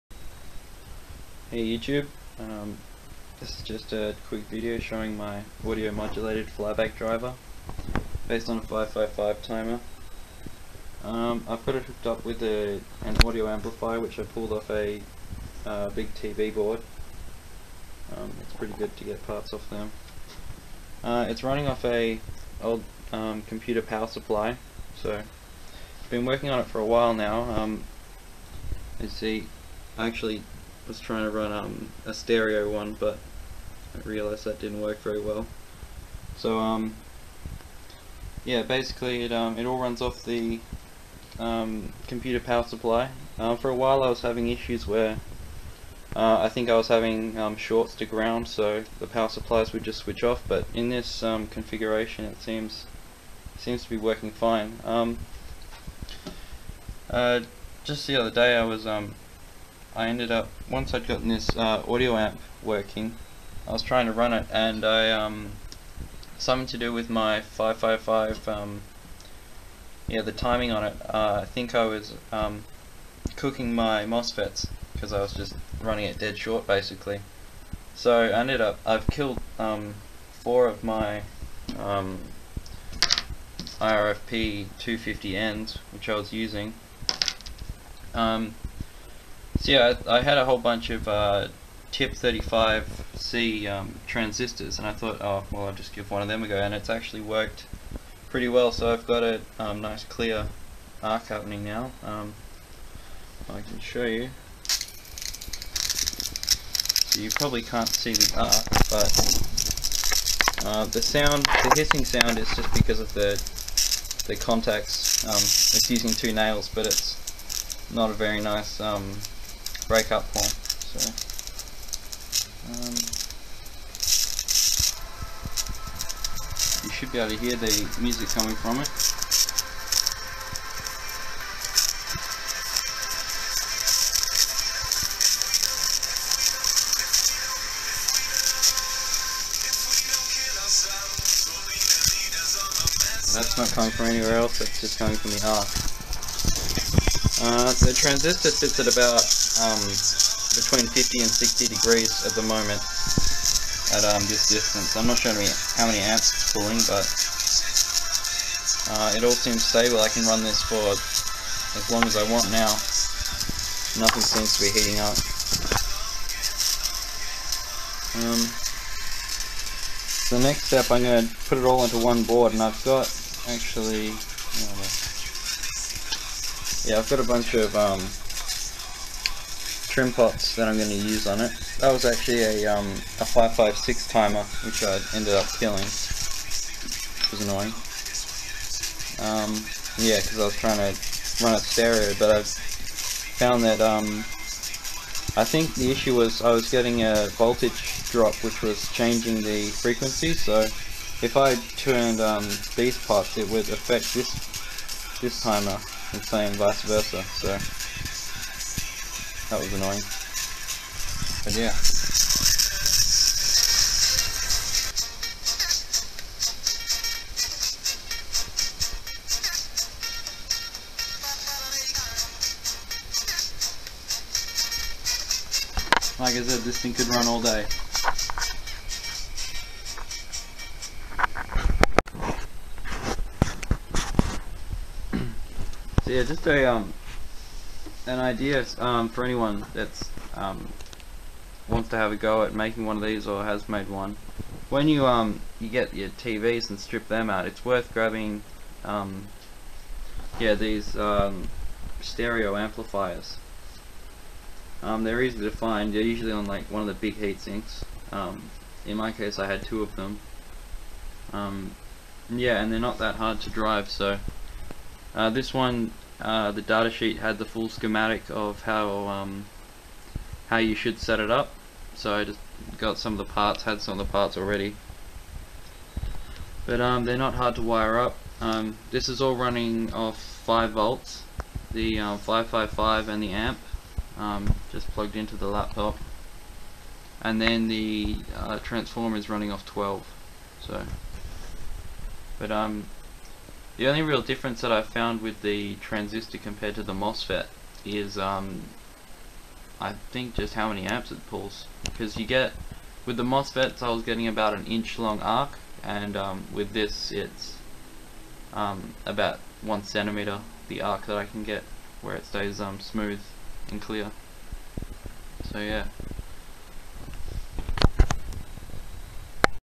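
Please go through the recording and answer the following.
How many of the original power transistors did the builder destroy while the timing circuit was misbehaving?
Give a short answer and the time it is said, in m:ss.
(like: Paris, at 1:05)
4, at 1:20.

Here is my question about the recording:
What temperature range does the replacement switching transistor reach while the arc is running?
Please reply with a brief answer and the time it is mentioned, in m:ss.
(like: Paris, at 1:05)
50 to 60 degrees, at 2:30.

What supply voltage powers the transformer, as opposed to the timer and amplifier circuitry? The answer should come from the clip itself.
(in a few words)
12 volts.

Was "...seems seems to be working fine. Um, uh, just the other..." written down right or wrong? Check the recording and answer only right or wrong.
right.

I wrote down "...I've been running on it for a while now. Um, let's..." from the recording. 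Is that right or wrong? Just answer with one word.
wrong.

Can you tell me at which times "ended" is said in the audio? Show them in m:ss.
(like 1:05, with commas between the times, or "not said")
1:00, 1:18, 3:05.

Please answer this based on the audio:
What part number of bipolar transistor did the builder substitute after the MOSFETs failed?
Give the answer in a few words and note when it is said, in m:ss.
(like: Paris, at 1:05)
TIP35C, at 1:31.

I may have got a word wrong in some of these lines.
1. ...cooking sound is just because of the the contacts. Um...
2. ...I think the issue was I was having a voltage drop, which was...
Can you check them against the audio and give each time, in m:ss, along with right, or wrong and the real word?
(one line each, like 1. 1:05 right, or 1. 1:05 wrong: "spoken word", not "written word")
1. 1:51 wrong: "hissing", not "cooking"
2. 3:15 wrong: "getting", not "having".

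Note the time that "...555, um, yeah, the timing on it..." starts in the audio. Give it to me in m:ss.
1:07.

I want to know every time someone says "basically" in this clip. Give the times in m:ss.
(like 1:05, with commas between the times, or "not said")
0:38, 1:16.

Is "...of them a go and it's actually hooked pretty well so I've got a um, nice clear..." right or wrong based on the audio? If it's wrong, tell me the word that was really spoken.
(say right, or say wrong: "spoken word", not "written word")
wrong: "worked", not "hooked".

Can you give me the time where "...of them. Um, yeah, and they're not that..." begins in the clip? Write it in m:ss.
4:19.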